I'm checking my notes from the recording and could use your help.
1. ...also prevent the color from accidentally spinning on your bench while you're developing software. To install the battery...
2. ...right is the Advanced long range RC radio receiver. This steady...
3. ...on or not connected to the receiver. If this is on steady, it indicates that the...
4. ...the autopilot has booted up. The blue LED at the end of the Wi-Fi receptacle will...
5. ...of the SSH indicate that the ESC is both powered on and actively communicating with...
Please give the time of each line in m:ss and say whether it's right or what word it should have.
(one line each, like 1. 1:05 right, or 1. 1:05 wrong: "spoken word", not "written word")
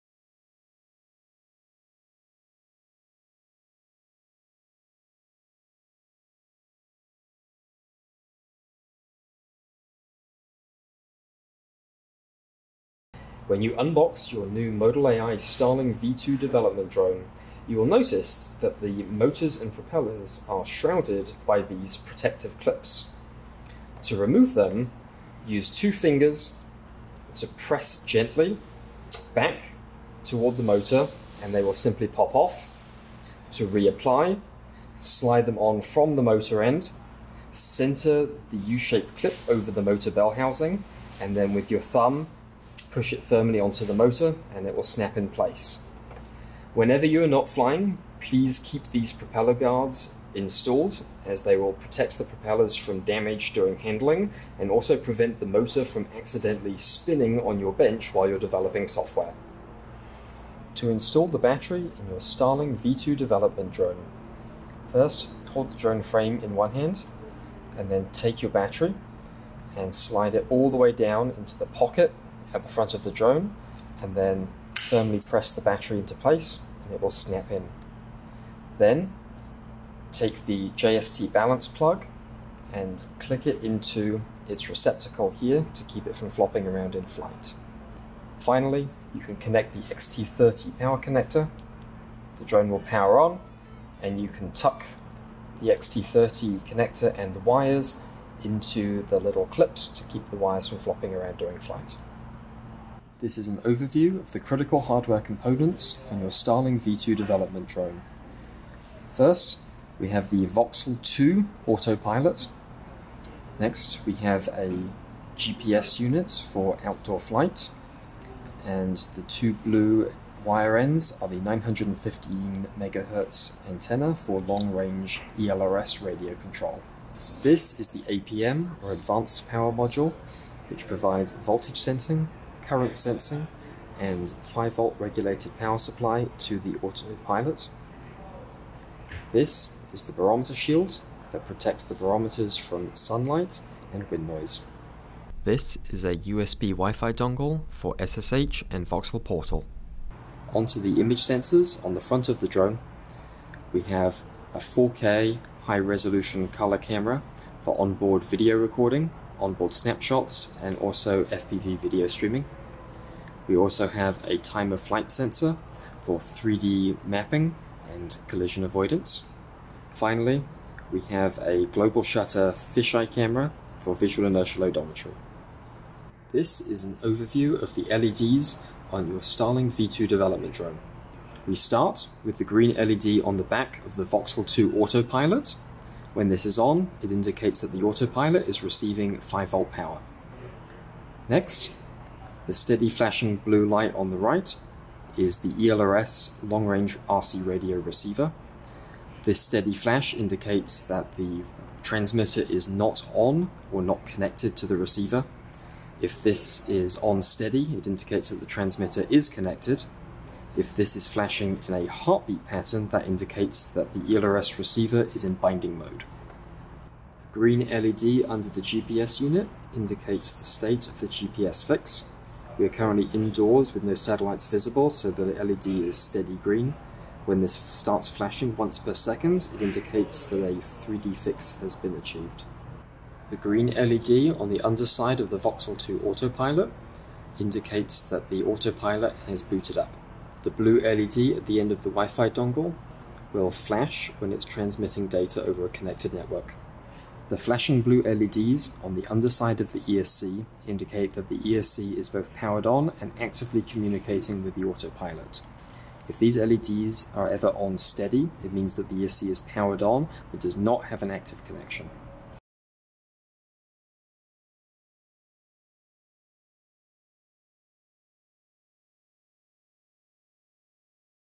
1. 0:54 wrong: "motor", not "color"
2. 3:14 wrong: "ELRS", not "Advanced"
3. 3:23 right
4. 3:58 wrong: "dongle", not "receptacle"
5. 4:09 wrong: "ESC", not "SSH".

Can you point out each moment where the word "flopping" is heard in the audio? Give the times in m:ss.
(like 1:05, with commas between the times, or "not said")
1:26, 1:40.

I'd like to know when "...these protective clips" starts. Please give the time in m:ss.
0:21.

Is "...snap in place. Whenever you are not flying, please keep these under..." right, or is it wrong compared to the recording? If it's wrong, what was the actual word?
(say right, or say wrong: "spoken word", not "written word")
wrong: "propeller", not "under".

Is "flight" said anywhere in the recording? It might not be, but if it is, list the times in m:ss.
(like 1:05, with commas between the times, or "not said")
1:27, 1:41, 1:57, 2:44.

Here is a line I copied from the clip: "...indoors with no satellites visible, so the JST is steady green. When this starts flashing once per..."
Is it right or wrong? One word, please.
wrong.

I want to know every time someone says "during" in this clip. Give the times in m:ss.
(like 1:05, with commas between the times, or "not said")
0:53, 1:41.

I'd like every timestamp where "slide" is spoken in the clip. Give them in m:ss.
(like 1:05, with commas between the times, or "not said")
0:34, 1:09.